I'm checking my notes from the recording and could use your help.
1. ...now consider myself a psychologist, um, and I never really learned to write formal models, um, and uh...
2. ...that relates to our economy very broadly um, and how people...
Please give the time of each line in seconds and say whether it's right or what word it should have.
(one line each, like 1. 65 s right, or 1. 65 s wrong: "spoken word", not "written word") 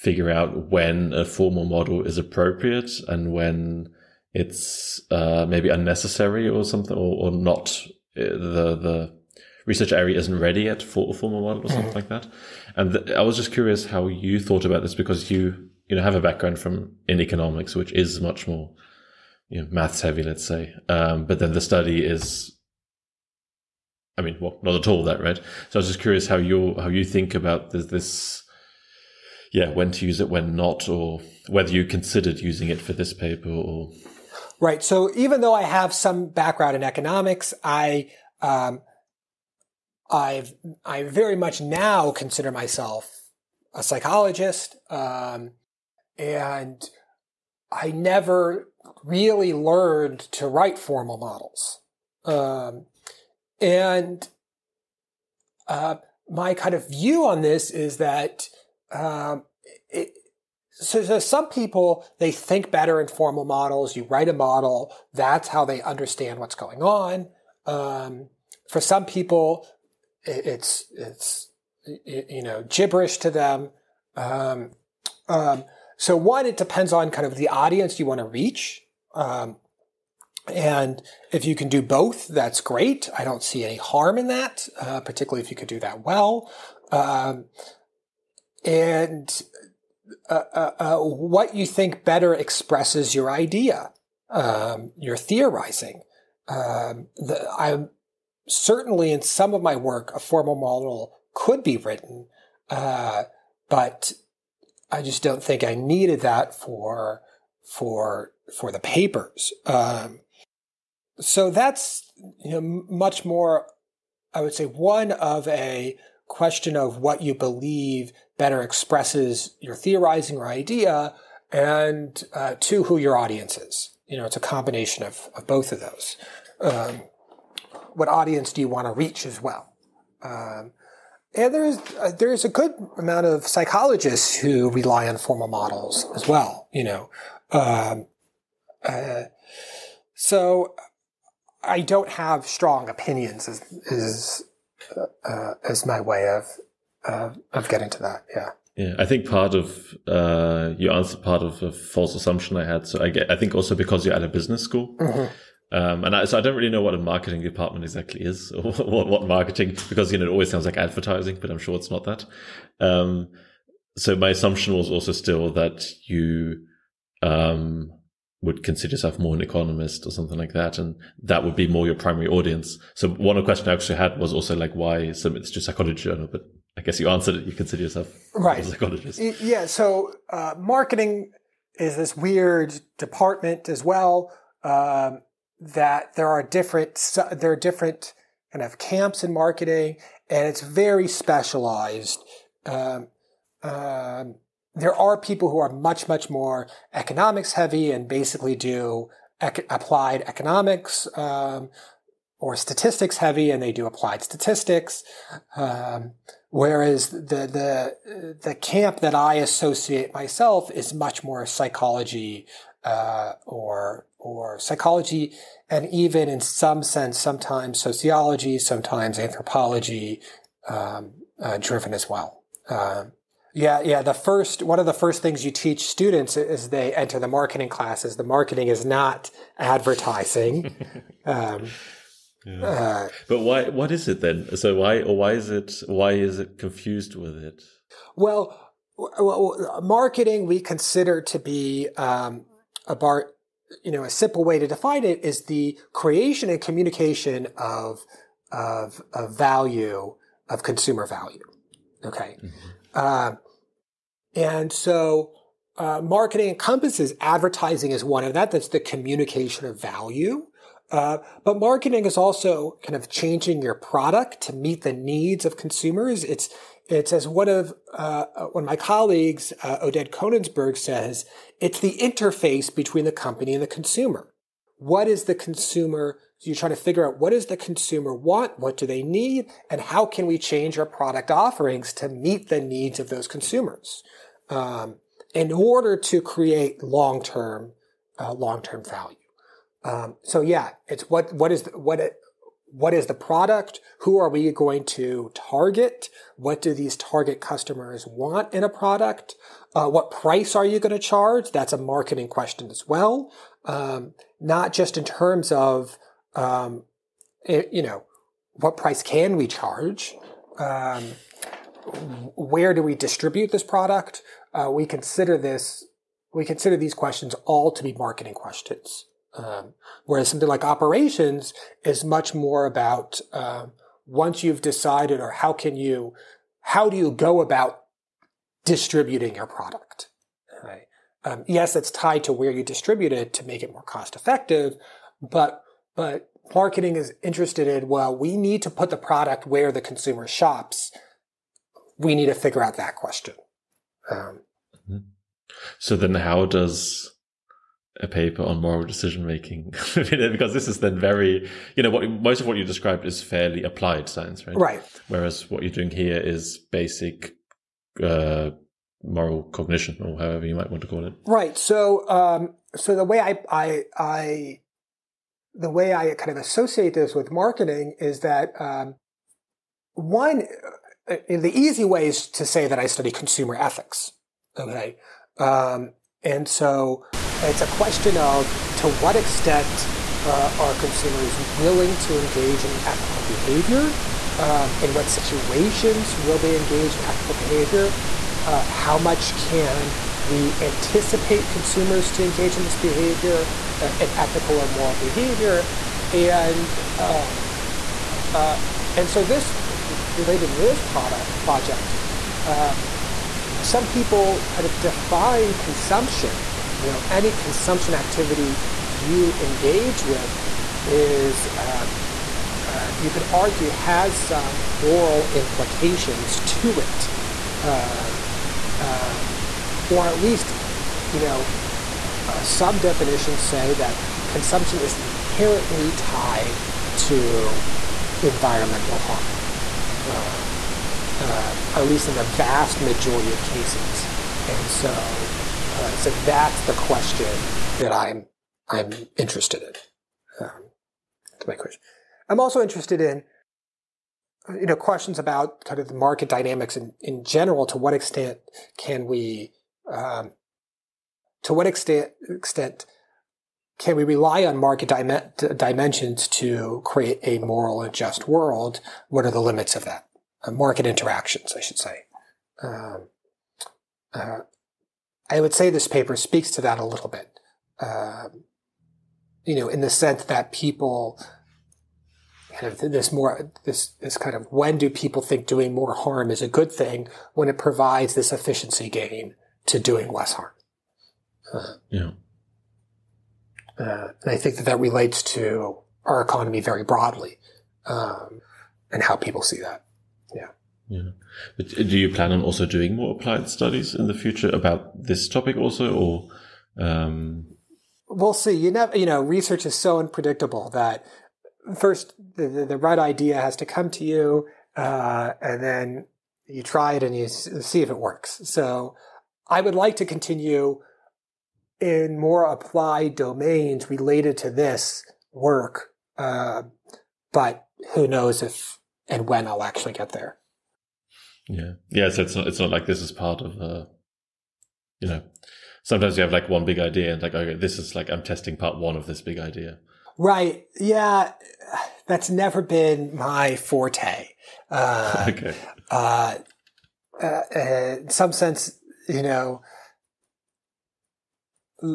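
1. 41 s right
2. 484 s right.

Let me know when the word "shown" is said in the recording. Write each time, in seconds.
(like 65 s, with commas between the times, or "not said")
not said.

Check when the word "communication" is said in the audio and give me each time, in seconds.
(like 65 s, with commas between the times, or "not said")
246 s, 258 s.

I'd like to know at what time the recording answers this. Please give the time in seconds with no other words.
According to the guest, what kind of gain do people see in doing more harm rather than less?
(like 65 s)
478 s.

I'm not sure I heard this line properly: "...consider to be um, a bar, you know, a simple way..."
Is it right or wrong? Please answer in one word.
right.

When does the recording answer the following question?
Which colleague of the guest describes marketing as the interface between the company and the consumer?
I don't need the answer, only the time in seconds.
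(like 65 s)
269 s.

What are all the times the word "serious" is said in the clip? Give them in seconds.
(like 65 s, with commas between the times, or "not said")
not said.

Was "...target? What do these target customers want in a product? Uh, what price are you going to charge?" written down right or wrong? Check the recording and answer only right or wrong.
right.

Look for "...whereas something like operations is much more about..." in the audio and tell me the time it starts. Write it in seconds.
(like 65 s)
320 s.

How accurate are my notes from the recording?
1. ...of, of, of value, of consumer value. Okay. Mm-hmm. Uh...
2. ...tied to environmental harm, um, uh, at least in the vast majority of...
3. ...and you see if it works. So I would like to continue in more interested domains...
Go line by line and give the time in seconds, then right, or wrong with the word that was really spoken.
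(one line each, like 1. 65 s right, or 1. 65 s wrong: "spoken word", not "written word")
1. 247 s right
2. 425 s right
3. 507 s wrong: "applied", not "interested".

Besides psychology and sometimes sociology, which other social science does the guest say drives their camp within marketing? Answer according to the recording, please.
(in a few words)
anthropology.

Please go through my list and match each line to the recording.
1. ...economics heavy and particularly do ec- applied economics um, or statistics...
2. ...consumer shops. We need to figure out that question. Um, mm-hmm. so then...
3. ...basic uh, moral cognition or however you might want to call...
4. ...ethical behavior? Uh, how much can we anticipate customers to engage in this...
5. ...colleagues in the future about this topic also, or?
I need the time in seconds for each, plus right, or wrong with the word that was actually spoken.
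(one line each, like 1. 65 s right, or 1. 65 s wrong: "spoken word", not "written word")
1. 196 s wrong: "basically", not "particularly"
2. 339 s right
3. 356 s right
4. 387 s wrong: "consumers", not "customers"
5. 493 s wrong: "studies", not "colleagues".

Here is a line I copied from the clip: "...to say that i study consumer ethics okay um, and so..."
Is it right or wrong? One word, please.
right.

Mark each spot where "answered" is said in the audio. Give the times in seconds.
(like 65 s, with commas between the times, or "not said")
150 s, 177 s.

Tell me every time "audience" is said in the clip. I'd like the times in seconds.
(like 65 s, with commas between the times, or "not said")
77 s, 123 s, 128 s, 172 s.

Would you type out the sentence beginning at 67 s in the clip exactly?
Um, for some people, it's it's you know gibberish to them.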